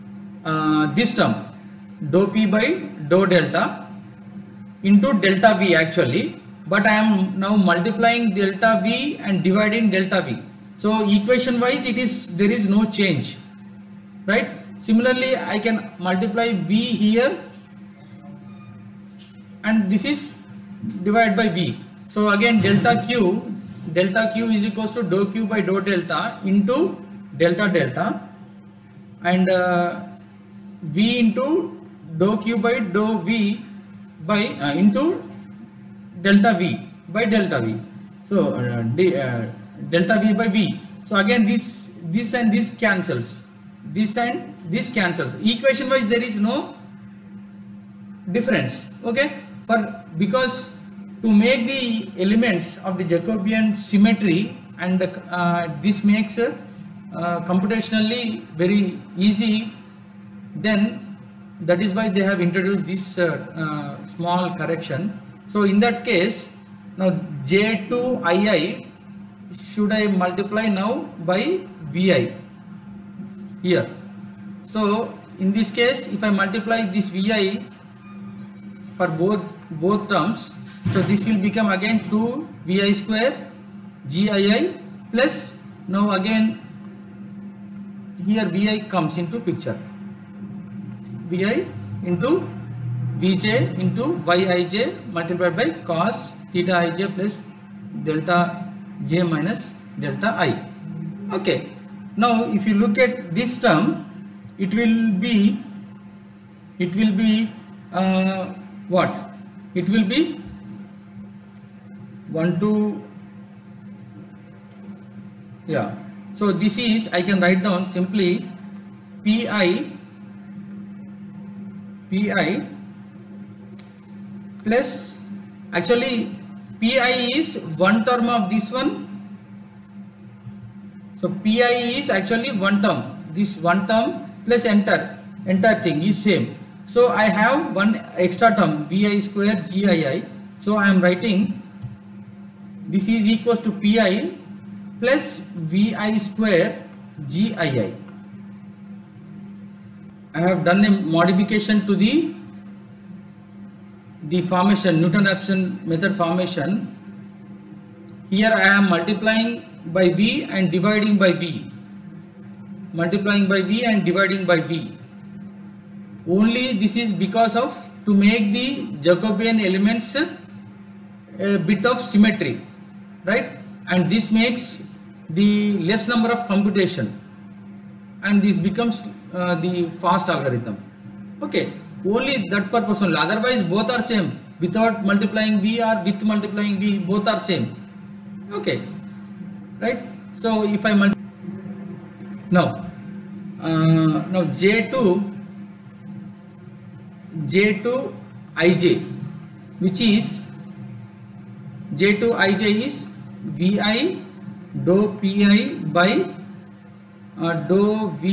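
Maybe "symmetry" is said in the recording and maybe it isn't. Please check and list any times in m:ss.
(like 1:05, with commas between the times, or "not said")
0:53, 2:51.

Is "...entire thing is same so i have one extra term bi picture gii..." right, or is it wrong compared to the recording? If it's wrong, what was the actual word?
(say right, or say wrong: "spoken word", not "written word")
wrong: "square", not "picture".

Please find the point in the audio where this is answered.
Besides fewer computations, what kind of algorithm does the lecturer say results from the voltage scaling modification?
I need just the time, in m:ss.
3:00.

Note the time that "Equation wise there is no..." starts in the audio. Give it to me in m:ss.
0:45.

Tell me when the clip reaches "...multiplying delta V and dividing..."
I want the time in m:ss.
0:07.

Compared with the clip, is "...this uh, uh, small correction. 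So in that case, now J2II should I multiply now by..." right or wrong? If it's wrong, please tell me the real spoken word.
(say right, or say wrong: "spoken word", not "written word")
right.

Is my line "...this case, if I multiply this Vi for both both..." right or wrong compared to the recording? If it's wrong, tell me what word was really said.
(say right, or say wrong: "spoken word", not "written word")
right.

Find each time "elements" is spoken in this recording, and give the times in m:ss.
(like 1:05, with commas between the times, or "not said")
0:52, 2:49.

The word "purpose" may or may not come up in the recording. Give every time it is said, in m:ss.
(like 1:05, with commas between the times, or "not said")
3:02.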